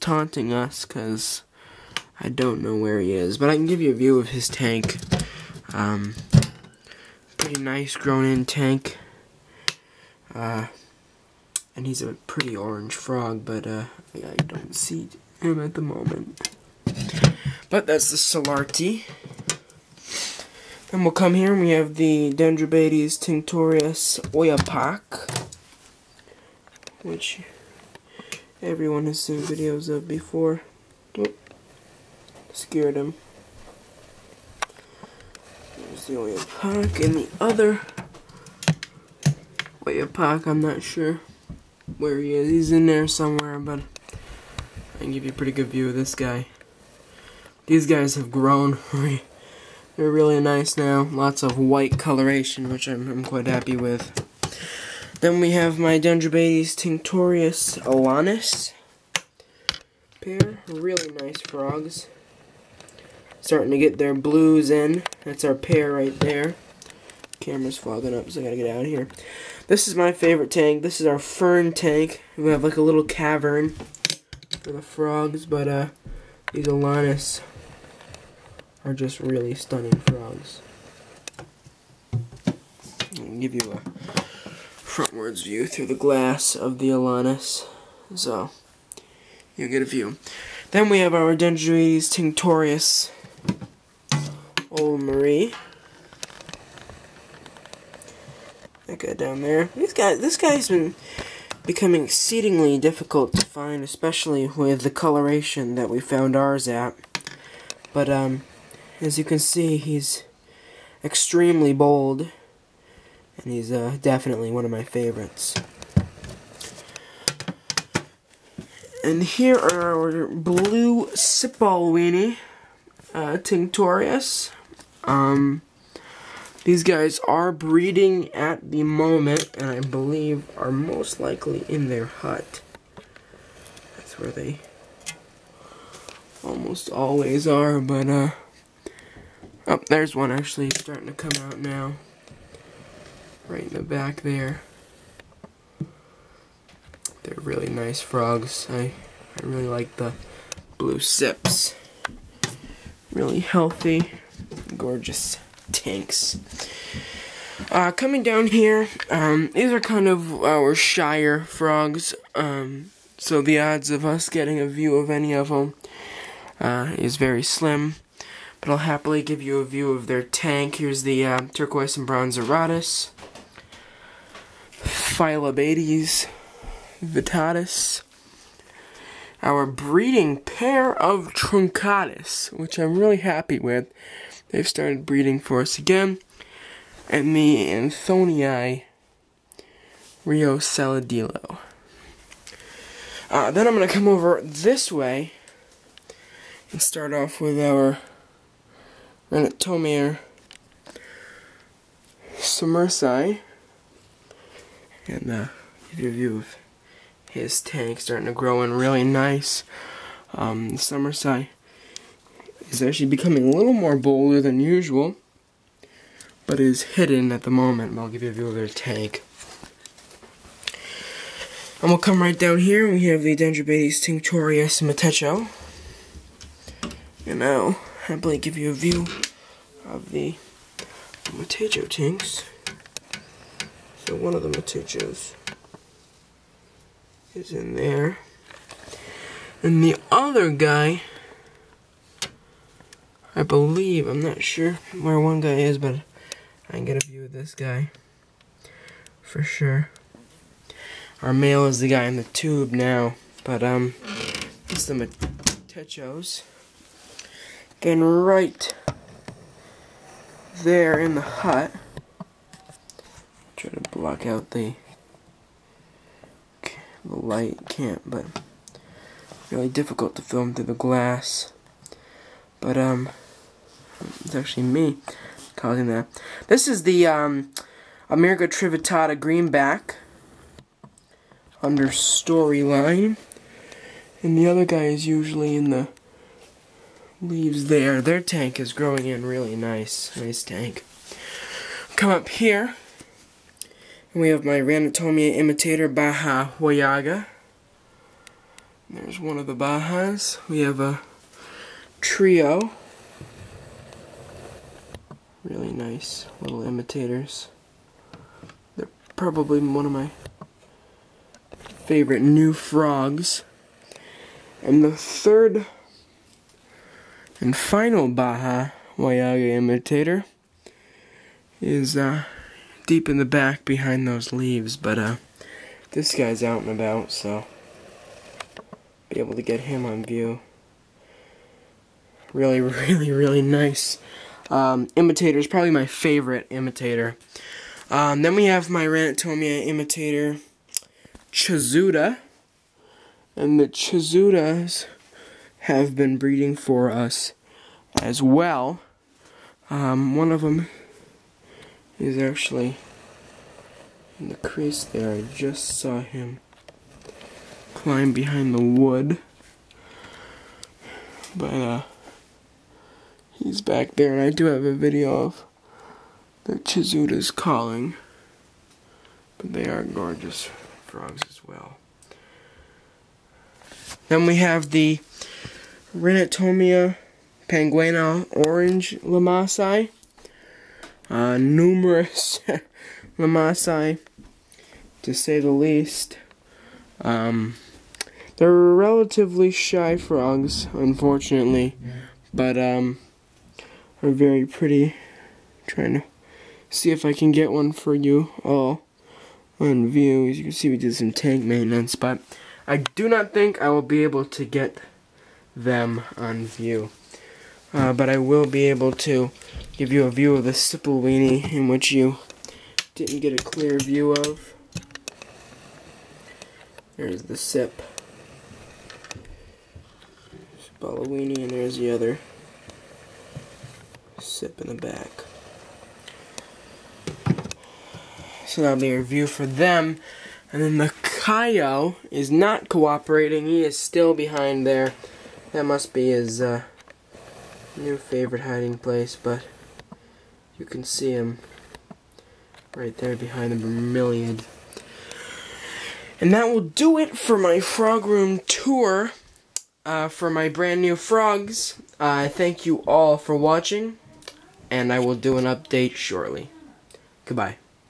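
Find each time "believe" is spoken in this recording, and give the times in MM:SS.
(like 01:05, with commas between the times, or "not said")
02:09, 04:03.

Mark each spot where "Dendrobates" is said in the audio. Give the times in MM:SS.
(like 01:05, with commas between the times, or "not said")
00:22, 00:55, 01:31, 03:43.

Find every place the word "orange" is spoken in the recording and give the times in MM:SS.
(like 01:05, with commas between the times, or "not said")
00:12, 06:18.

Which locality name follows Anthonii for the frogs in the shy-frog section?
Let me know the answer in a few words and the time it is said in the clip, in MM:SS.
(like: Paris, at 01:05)
Rio Saladillo, at 03:10.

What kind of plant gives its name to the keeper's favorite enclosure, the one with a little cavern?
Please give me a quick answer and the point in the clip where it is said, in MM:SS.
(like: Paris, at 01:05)
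Fern, at 01:11.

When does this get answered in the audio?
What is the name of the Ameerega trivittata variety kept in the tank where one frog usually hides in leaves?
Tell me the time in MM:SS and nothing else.
04:39.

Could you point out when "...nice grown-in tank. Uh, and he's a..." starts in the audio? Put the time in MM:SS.
00:07.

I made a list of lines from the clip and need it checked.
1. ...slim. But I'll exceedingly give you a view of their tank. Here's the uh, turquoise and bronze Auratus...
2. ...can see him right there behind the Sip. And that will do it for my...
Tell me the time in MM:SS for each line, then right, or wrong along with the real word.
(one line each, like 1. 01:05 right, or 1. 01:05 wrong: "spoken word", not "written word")
1. 02:47 wrong: "happily", not "exceedingly"
2. 07:20 wrong: "Vermilion", not "Sip".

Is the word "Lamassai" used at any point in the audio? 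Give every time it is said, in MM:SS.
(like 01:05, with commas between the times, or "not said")
06:18, 06:23.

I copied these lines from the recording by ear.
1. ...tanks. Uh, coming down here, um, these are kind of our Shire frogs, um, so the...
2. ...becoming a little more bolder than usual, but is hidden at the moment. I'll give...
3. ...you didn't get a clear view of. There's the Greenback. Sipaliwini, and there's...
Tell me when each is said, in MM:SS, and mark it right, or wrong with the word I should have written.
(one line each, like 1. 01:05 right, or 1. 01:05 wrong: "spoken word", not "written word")
1. 02:35 right
2. 03:33 right
3. 06:51 wrong: "Sip", not "Greenback".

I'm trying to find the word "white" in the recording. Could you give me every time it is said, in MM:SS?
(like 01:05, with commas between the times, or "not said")
00:51.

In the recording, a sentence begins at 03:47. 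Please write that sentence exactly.
And I'll happily give you a view of the matecho tinks.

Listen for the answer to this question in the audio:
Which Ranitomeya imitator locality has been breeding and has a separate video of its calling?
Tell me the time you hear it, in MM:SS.
05:41.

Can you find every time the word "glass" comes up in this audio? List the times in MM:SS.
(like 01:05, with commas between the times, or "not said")
01:25, 04:30.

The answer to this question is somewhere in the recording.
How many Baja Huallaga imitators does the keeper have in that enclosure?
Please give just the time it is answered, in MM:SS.
05:02.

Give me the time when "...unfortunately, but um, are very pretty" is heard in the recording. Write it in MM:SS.
06:30.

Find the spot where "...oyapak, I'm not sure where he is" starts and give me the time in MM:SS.
00:39.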